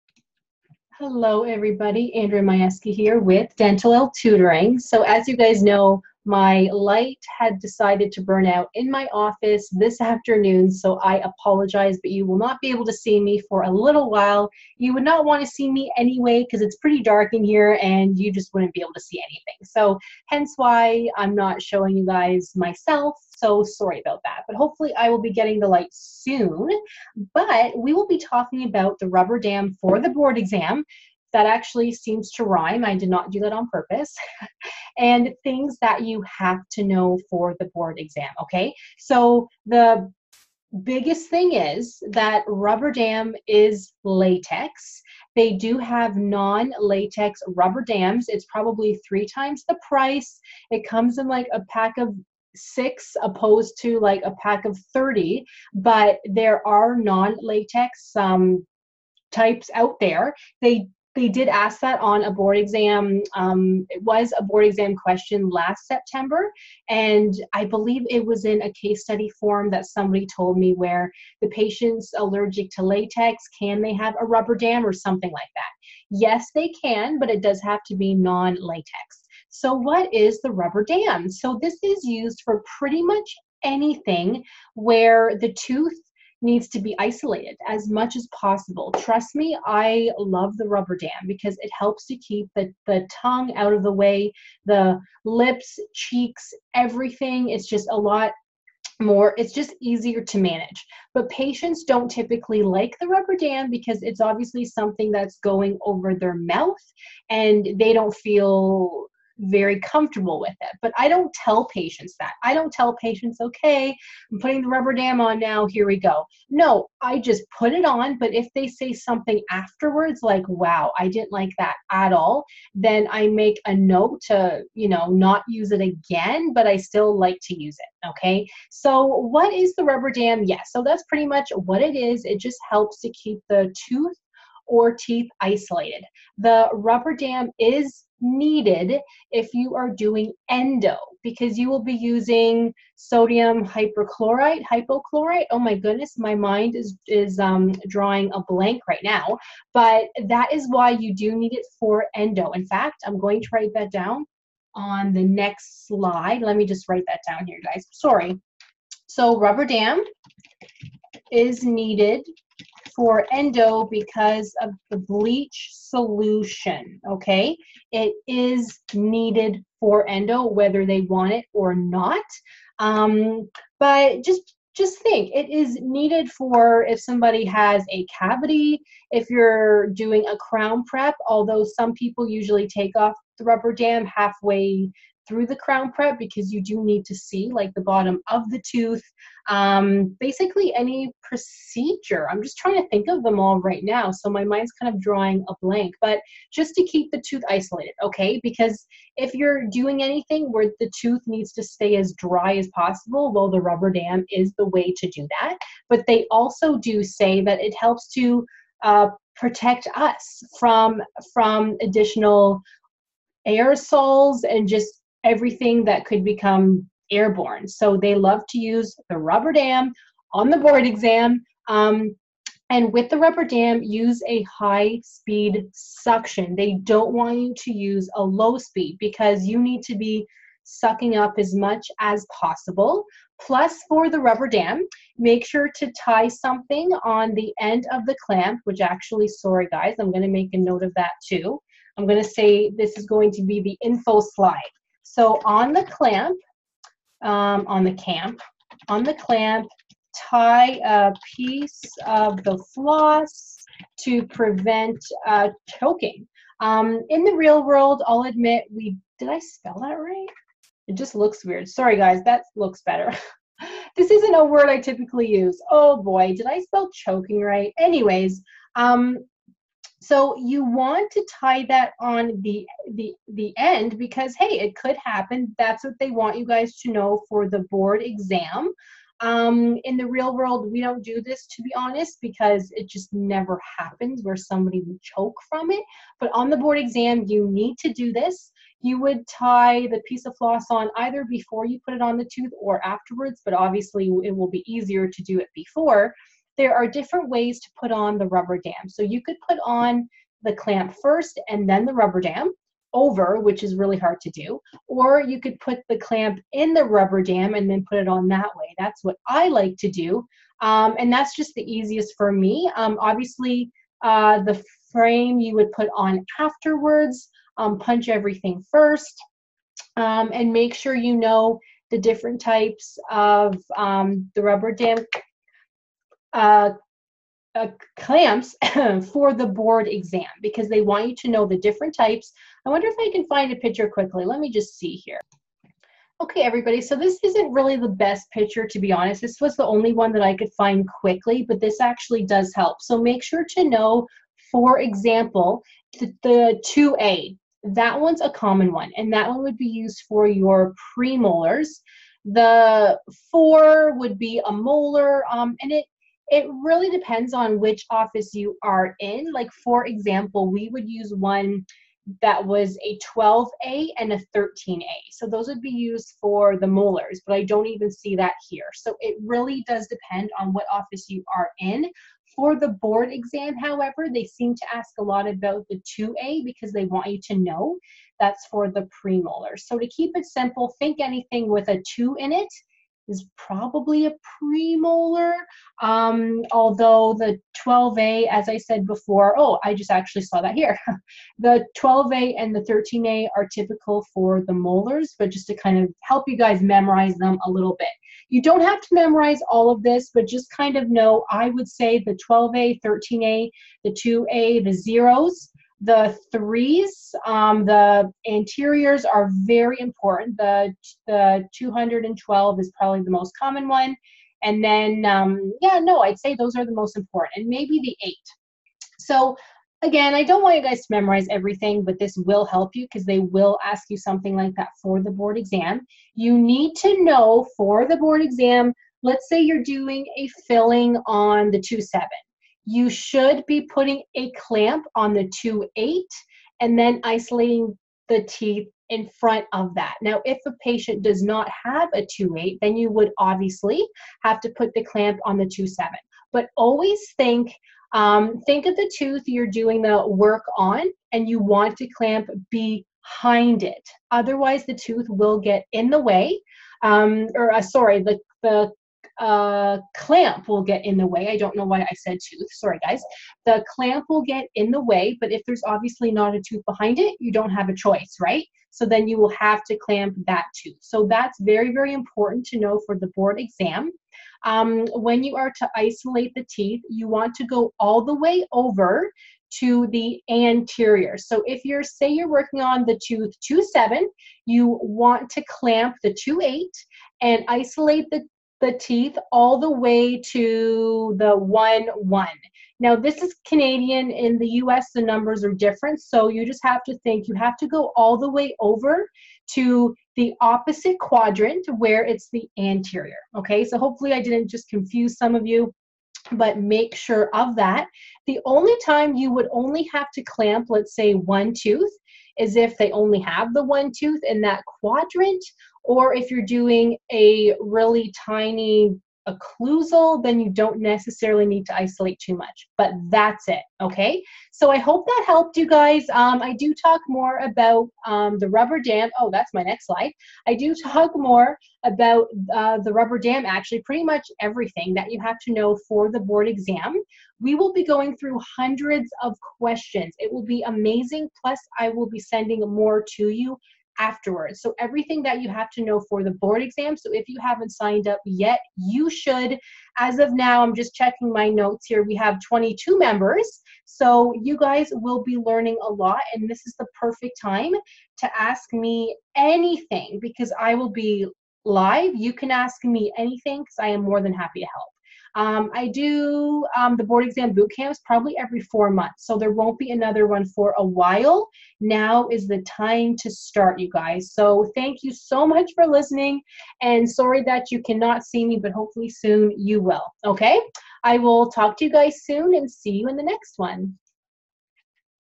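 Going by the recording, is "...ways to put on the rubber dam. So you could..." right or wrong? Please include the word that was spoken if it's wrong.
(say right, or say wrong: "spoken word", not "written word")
right.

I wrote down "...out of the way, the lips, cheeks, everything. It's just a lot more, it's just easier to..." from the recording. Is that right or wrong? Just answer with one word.
right.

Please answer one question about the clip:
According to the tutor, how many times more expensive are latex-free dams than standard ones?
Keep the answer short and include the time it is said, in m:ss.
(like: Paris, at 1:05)
3 times, at 0:49.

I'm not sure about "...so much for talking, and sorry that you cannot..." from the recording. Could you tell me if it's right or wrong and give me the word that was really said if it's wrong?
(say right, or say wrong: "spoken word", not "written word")
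wrong: "listening", not "talking".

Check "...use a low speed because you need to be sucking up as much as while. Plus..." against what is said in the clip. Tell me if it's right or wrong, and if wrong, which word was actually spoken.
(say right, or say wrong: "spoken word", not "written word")
wrong: "possible", not "while".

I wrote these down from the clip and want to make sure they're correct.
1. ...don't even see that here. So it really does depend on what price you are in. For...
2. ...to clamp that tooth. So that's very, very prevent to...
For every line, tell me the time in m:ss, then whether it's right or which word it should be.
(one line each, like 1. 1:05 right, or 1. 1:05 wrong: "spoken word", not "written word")
1. 6:07 wrong: "office", not "price"
2. 7:49 wrong: "important", not "prevent".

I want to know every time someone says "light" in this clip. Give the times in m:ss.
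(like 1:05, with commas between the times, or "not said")
0:06, 0:25.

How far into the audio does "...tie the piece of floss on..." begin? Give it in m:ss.
4:49.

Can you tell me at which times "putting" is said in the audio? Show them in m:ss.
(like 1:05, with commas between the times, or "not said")
1:54, 7:13.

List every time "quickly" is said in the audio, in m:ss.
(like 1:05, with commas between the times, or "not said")
5:33, 5:40.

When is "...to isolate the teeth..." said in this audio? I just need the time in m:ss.
7:55.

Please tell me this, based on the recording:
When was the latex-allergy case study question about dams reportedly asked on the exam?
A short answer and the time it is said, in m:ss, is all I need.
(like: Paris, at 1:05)
last September, at 1:05.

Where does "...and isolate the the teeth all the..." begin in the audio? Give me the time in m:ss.
8:07.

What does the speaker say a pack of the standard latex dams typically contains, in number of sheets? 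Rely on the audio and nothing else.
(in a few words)
30.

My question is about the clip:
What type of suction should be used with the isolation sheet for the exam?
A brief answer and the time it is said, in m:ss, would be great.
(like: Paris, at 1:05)
high speed suction, at 3:44.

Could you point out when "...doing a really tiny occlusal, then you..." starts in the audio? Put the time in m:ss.
8:36.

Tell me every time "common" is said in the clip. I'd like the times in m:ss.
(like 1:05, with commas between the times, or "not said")
5:48, 6:53.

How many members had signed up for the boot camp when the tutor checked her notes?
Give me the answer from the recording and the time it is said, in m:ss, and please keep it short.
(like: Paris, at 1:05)
22, at 9:12.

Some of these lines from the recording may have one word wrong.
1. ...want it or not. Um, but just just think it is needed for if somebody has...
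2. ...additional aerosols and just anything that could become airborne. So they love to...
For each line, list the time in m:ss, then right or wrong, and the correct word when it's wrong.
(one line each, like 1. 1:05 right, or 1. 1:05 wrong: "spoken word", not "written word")
1. 2:51 right
2. 3:31 wrong: "everything", not "anything".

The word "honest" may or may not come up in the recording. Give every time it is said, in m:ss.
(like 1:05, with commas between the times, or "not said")
4:41, 5:38.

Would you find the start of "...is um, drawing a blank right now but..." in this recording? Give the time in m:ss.
2:27.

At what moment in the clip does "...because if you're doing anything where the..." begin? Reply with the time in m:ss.
3:18.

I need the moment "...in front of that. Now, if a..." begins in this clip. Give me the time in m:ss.
7:18.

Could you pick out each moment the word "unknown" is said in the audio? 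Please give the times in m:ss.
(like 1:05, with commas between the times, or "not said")
not said.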